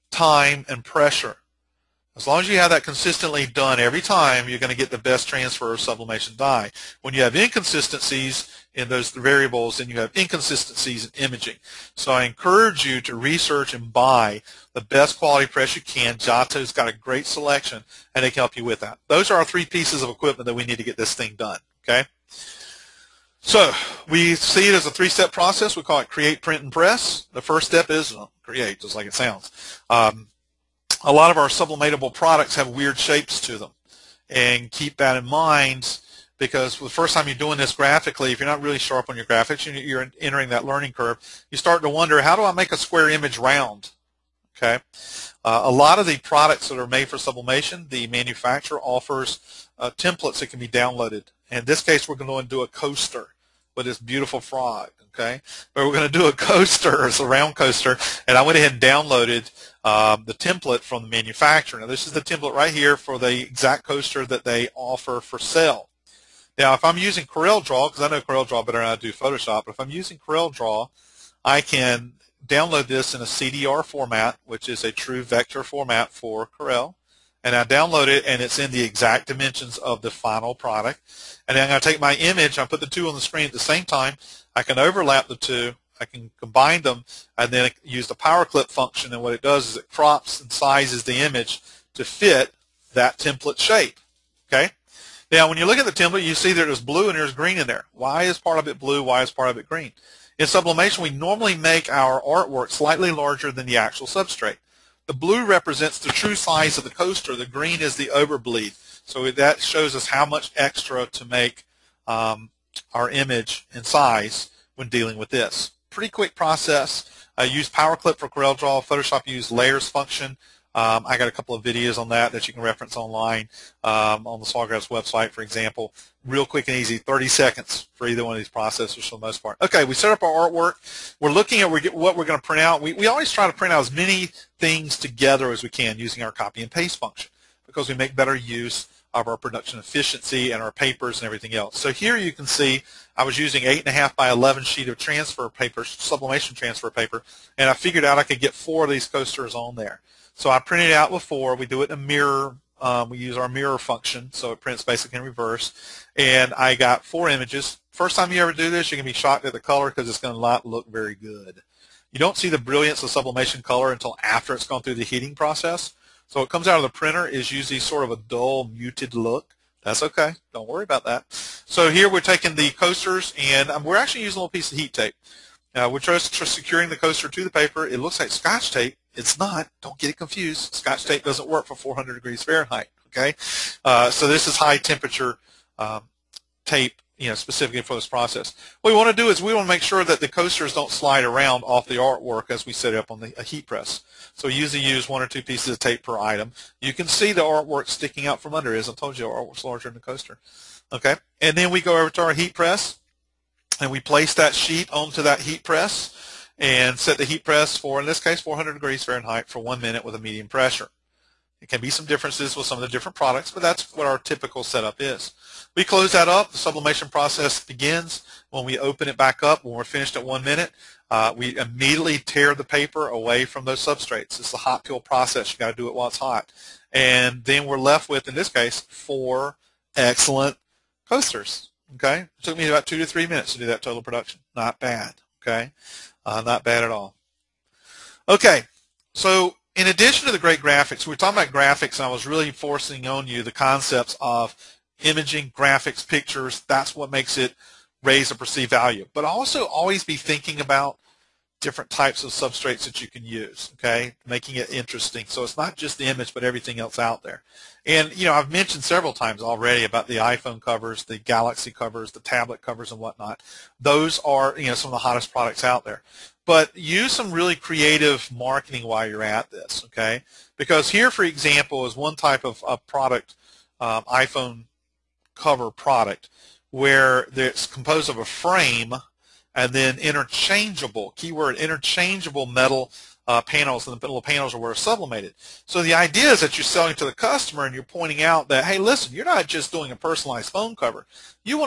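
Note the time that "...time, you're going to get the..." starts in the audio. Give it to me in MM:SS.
00:04.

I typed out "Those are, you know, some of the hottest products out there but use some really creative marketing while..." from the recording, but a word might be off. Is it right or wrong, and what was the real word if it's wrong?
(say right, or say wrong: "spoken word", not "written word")
right.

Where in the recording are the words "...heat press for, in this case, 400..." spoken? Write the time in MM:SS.
03:27.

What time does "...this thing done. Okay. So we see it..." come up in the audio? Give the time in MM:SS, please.
00:20.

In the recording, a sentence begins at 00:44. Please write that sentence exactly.
Okay, uh, A lot of the products that are made for sublimation, the manufacturer offers uh, templates that can be downloaded.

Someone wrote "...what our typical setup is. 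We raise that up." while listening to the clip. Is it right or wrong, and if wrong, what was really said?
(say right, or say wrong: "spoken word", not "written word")
wrong: "close", not "raise".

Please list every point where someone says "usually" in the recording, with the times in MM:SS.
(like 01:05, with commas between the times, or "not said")
02:47, 03:14.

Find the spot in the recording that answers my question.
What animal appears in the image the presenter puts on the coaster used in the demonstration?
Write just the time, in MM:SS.
00:54.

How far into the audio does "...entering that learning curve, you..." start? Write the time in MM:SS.
00:40.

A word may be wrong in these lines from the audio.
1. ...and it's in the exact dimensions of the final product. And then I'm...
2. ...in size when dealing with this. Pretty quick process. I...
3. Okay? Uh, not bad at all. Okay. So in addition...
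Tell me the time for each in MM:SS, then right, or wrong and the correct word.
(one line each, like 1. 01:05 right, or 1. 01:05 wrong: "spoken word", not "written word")
1. 01:18 right
2. 01:53 right
3. 03:55 right.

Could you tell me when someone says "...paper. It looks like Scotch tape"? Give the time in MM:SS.
02:57.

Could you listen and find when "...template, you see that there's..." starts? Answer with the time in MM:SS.
01:35.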